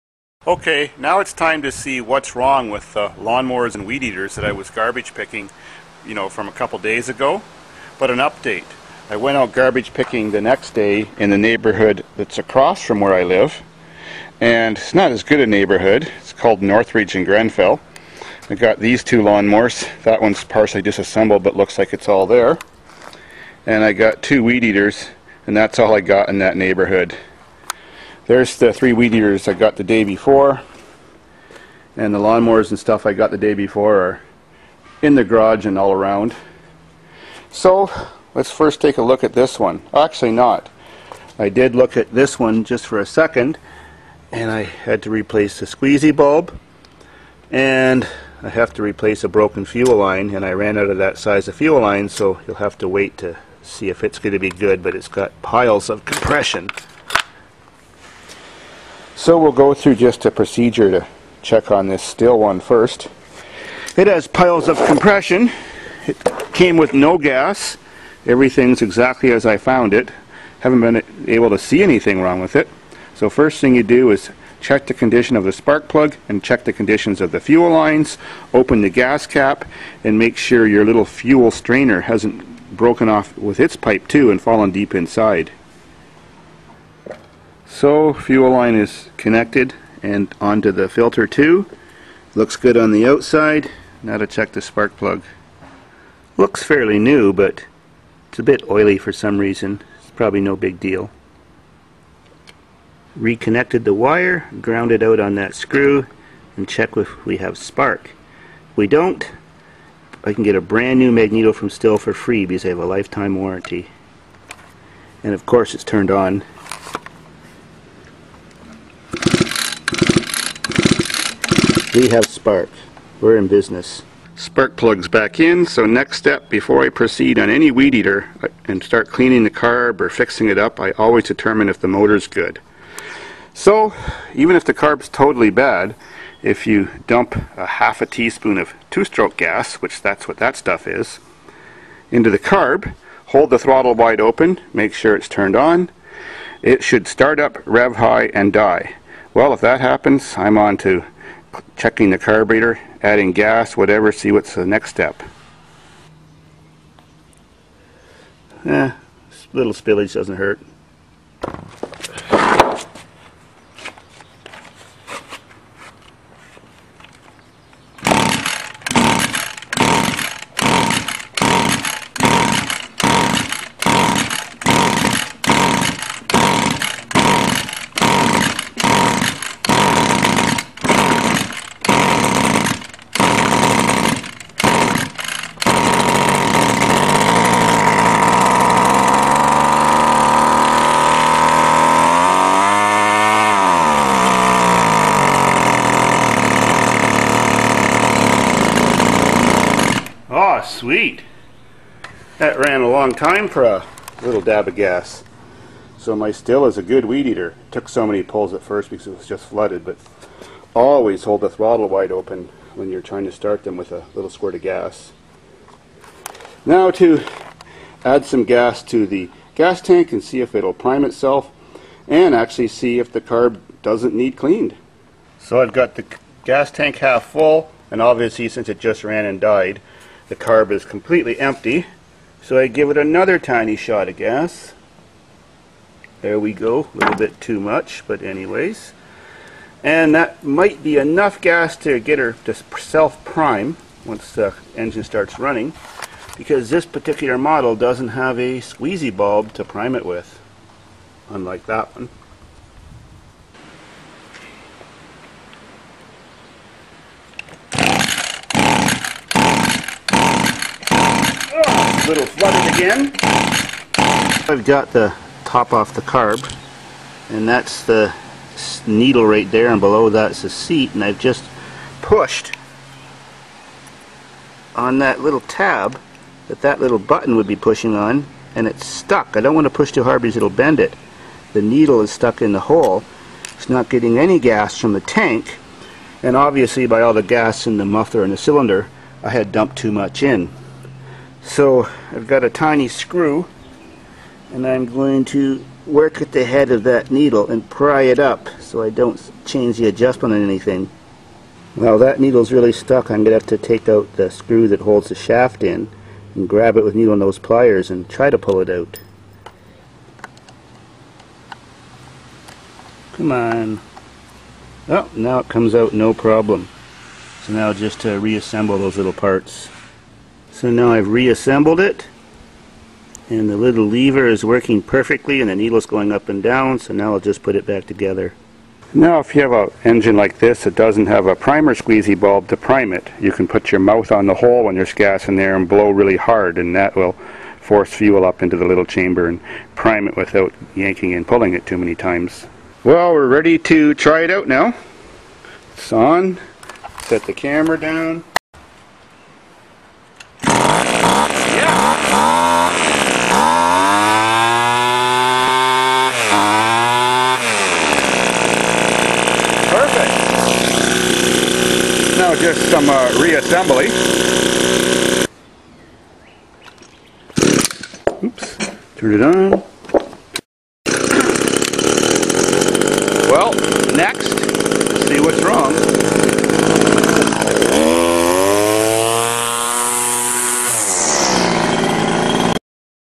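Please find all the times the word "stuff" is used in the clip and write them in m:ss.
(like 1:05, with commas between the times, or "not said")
0:32, 2:20.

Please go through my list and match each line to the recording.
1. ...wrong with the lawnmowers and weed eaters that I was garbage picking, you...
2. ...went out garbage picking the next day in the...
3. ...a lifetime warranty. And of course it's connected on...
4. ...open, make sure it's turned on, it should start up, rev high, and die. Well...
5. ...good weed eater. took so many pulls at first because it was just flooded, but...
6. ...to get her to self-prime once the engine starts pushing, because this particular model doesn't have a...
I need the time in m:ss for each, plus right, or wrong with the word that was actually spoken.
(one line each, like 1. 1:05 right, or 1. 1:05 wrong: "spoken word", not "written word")
1. 0:02 right
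2. 0:09 right
3. 1:52 wrong: "turned", not "connected"
4. 2:24 right
5. 3:26 right
6. 4:01 wrong: "running", not "pushing".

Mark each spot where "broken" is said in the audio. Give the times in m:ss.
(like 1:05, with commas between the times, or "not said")
0:49, 1:22.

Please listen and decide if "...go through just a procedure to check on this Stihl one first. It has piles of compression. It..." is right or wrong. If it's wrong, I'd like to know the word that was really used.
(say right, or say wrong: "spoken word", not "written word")
right.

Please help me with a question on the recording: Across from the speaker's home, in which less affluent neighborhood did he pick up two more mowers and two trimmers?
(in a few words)
Northridge and Grenfell.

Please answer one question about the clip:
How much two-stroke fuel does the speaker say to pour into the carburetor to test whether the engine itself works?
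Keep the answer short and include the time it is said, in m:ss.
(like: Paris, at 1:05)
half a teaspoon, at 2:17.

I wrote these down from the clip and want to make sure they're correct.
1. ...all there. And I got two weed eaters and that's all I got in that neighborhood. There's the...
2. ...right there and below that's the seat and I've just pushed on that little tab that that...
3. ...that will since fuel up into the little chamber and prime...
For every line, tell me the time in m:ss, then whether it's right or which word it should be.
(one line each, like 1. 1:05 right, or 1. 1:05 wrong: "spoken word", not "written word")
1. 0:22 right
2. 4:29 right
3. 5:36 wrong: "force", not "since".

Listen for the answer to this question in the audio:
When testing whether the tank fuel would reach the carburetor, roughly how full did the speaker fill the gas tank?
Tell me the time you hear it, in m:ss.
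3:46.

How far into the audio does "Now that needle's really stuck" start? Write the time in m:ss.
5:01.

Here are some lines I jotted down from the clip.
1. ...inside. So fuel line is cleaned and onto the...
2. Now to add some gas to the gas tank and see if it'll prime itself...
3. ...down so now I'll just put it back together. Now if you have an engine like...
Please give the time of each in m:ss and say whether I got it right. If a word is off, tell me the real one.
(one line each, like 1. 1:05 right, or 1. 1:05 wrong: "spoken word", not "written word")
1. 1:24 wrong: "connected", not "cleaned"
2. 3:36 right
3. 5:26 right.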